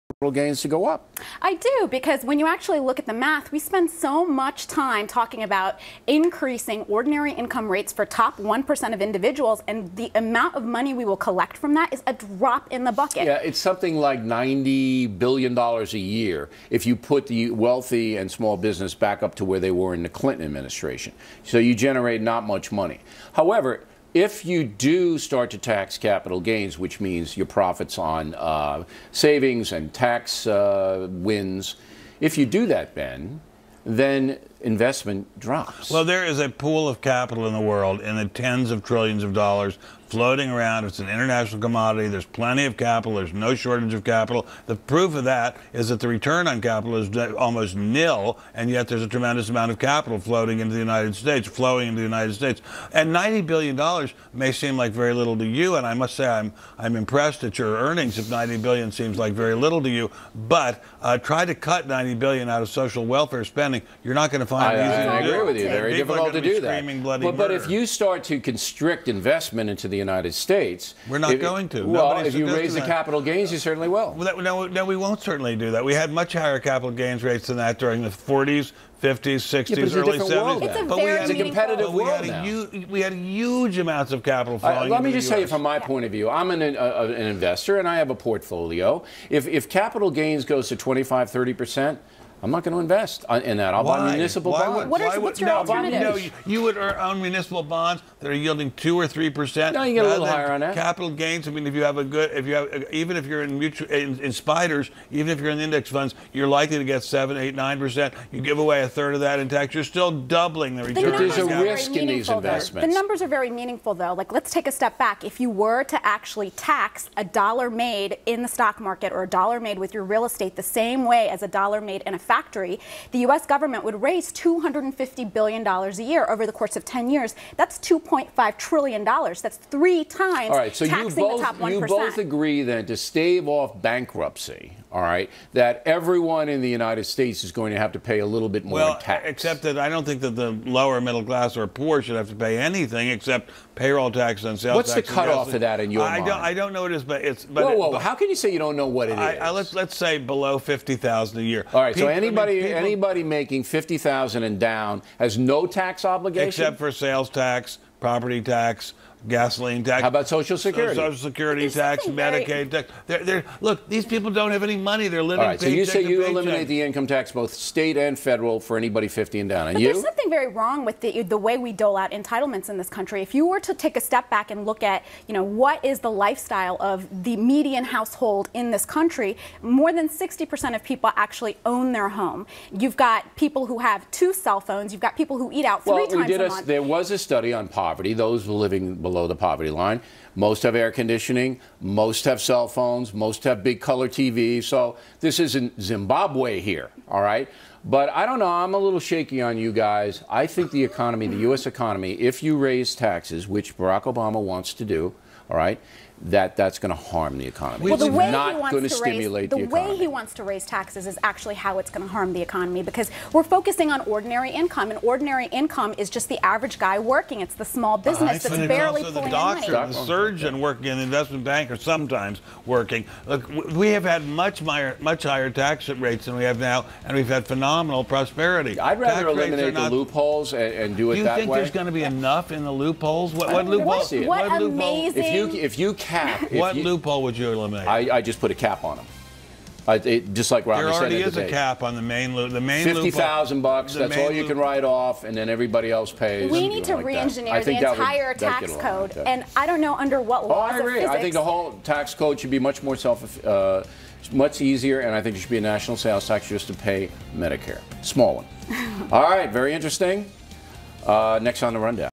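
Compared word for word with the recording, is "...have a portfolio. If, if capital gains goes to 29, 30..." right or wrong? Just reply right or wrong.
wrong.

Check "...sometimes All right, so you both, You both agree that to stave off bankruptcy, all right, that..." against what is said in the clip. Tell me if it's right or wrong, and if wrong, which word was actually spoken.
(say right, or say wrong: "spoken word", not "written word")
wrong: "times", not "sometimes".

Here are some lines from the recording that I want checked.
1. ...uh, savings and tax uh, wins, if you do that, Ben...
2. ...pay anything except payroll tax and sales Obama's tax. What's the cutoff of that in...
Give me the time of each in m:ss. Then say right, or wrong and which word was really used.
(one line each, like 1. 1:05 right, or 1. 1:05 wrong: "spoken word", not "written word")
1. 0:28 right
2. 2:22 wrong: "What", not "Obama".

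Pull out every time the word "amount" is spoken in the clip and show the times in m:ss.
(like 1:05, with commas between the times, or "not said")
0:10, 0:49, 1:23.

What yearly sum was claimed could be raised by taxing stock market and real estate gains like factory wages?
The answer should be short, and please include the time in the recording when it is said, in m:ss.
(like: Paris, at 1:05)
$250 billion, at 2:04.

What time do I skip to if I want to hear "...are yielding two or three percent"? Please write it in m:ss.
1:38.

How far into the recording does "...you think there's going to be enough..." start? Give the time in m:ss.
3:51.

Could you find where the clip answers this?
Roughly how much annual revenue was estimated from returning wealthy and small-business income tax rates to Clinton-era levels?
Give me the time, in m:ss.
0:14.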